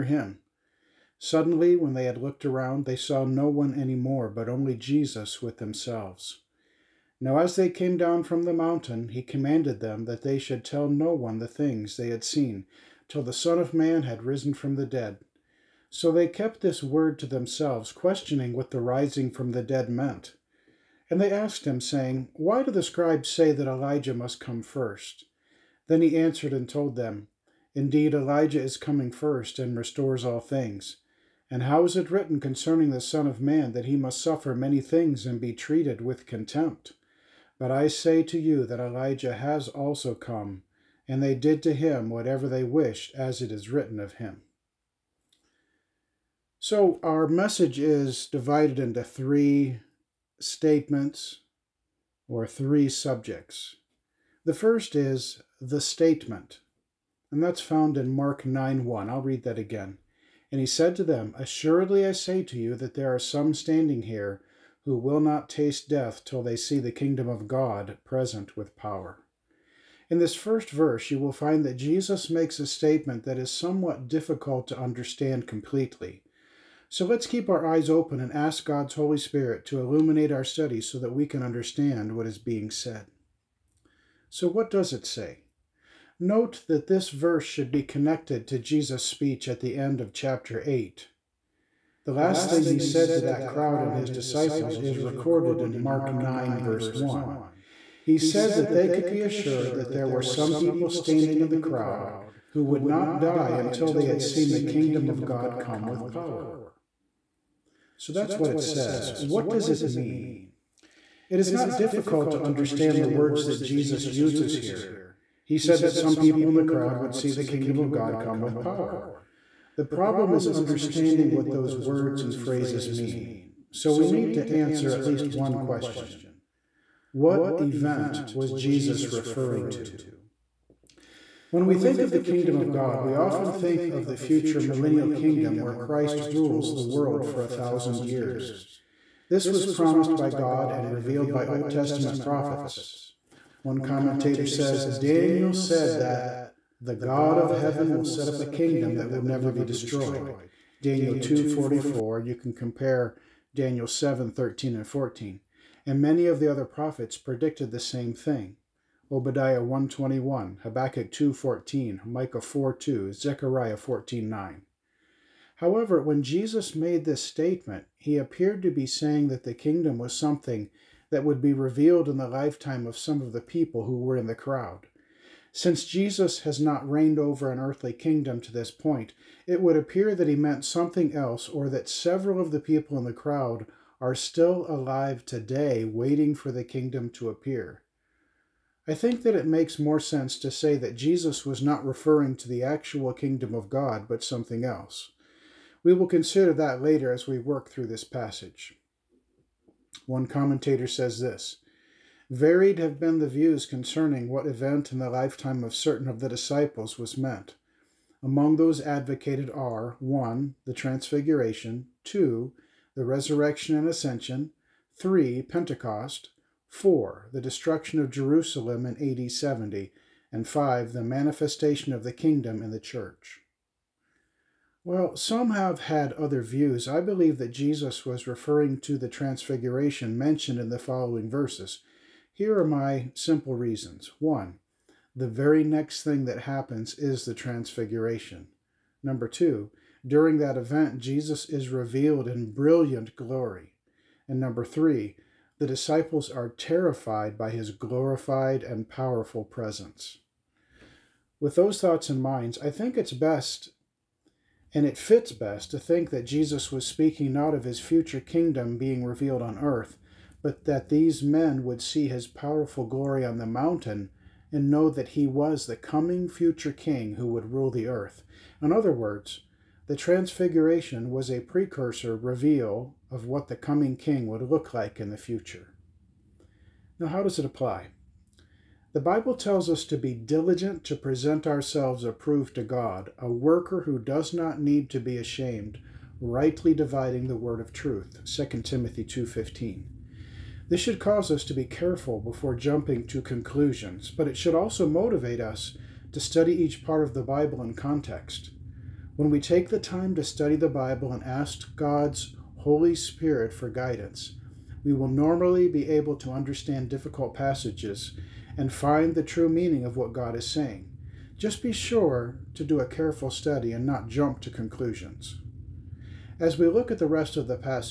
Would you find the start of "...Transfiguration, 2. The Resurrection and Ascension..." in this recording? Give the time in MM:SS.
03:30.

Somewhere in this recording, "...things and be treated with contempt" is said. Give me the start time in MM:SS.
00:34.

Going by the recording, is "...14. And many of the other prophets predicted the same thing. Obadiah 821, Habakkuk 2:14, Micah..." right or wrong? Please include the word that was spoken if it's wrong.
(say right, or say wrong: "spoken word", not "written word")
wrong: "121", not "821".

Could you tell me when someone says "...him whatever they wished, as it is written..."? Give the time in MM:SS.
00:41.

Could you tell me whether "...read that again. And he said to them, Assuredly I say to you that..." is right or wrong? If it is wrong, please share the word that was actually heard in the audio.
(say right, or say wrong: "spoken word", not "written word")
right.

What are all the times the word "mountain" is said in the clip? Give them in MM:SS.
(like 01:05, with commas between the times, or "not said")
00:08, 04:23.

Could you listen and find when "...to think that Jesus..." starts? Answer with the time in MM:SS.
04:15.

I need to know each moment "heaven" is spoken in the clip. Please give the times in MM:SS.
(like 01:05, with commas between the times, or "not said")
02:27.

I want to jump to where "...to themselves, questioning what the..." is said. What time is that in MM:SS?
00:17.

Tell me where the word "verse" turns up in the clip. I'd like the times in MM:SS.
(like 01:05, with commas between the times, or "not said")
01:10, 01:27, 01:36, 03:51.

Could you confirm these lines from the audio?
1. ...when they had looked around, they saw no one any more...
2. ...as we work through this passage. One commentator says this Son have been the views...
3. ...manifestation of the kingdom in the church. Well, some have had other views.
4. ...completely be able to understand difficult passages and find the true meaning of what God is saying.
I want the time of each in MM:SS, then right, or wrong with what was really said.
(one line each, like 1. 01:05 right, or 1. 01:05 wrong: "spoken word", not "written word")
1. 00:01 right
2. 03:17 wrong: "Varied", not "Son"
3. 03:41 right
4. 05:05 wrong: "normally", not "completely".